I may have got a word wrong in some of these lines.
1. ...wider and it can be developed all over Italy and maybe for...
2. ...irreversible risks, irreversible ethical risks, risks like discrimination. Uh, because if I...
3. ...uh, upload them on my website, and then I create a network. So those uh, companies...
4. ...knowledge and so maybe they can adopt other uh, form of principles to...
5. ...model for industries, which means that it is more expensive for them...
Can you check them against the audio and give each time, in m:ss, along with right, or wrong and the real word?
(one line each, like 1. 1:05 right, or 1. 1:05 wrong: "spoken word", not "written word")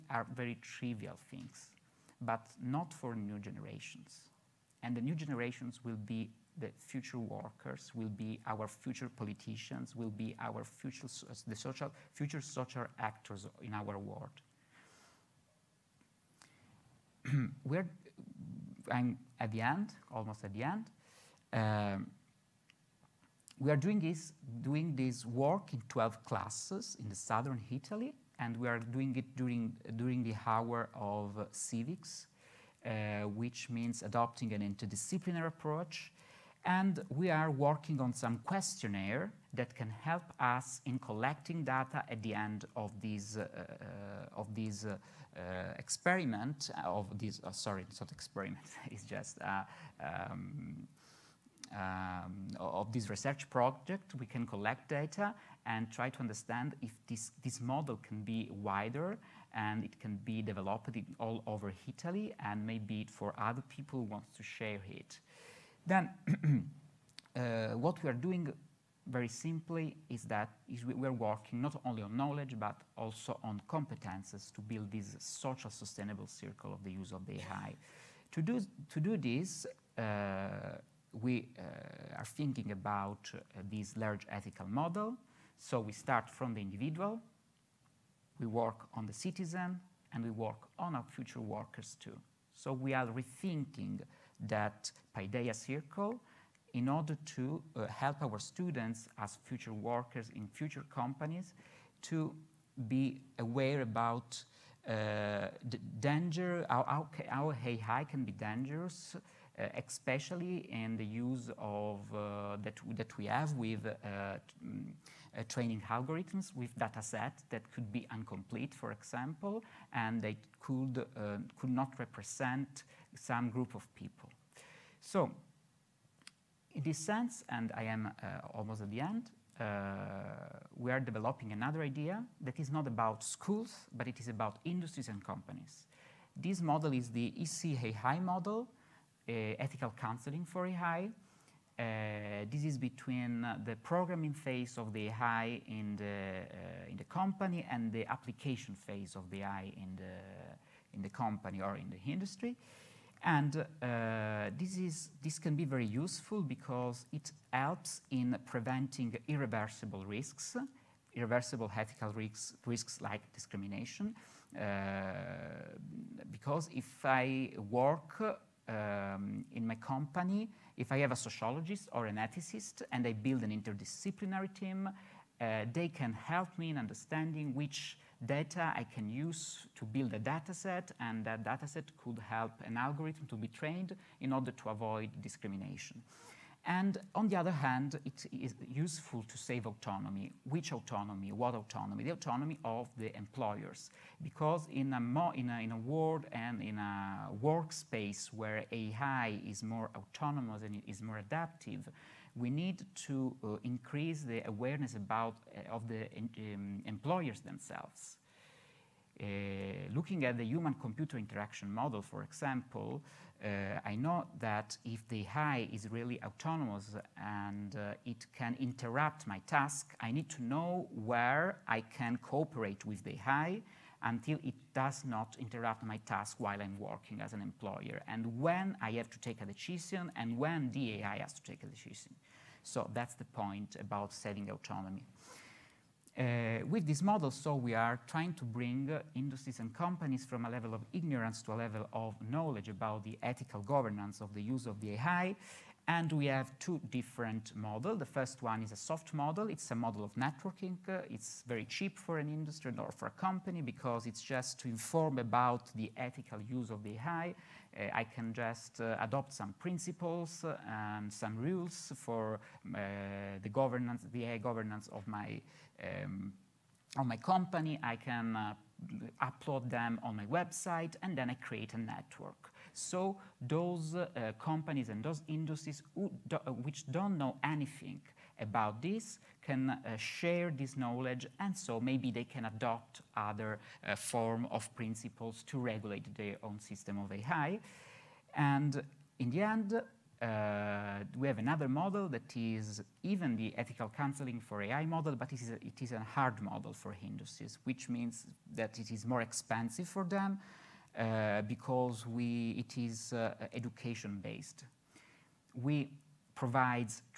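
1. 0:58 right
2. 2:39 right
3. 4:28 right
4. 4:40 right
5. 4:56 right.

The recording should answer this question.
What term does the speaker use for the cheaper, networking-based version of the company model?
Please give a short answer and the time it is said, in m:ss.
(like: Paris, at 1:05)
soft model, at 4:08.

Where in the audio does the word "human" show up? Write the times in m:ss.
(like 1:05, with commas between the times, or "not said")
3:30.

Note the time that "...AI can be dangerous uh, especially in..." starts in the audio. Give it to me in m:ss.
1:47.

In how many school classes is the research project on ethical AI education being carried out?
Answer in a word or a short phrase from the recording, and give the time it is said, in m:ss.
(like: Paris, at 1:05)
12, at 0:25.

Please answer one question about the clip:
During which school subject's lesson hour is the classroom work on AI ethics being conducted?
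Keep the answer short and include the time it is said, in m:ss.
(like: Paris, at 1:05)
civics, at 0:31.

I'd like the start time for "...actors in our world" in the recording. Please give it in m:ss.
0:12.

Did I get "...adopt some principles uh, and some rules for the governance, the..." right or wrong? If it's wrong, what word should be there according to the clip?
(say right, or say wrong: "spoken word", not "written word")
right.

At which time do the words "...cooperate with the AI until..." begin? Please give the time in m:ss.
3:42.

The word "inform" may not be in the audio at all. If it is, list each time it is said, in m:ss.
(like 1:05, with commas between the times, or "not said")
4:14.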